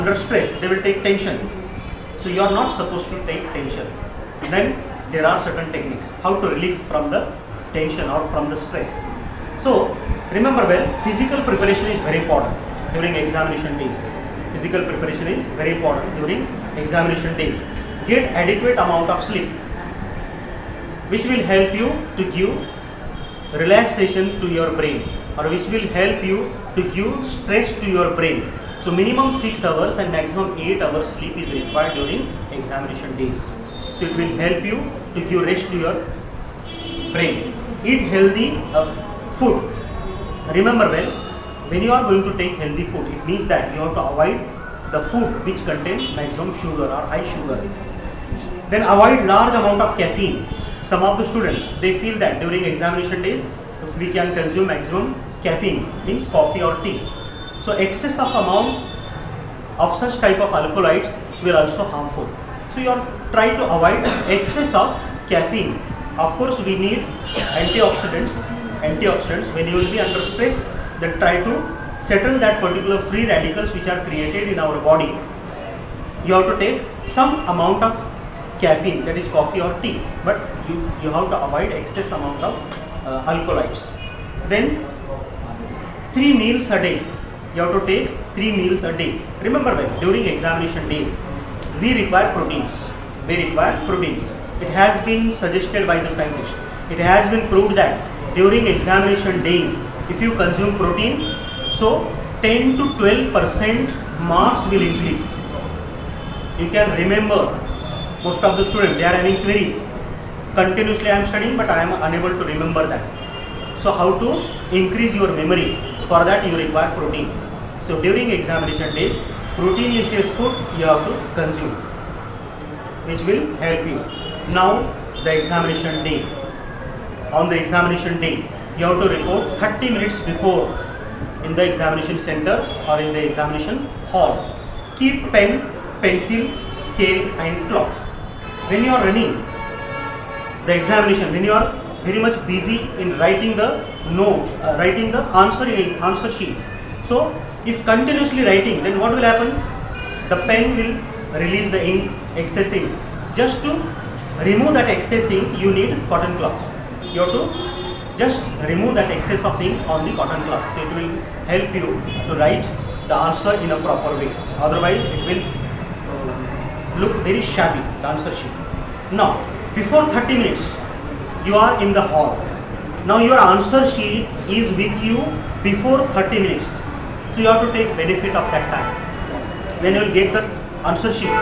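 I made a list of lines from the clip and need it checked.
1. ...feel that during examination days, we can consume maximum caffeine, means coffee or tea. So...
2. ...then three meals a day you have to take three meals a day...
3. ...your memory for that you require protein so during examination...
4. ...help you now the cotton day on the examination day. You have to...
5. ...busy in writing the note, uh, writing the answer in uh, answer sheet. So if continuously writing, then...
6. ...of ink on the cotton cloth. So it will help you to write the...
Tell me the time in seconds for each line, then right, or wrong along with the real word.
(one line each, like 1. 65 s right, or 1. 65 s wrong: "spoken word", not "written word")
1. 51 s right
2. 84 s right
3. 115 s right
4. 123 s wrong: "examination", not "cotton"
5. 142 s right
6. 159 s right.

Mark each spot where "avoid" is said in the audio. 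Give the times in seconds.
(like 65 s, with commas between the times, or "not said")
44 s, 48 s, 63 s, 81 s.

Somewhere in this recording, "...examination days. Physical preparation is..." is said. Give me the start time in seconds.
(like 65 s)
13 s.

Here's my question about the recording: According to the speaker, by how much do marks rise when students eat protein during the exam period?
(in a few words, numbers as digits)
10 to 12 percent.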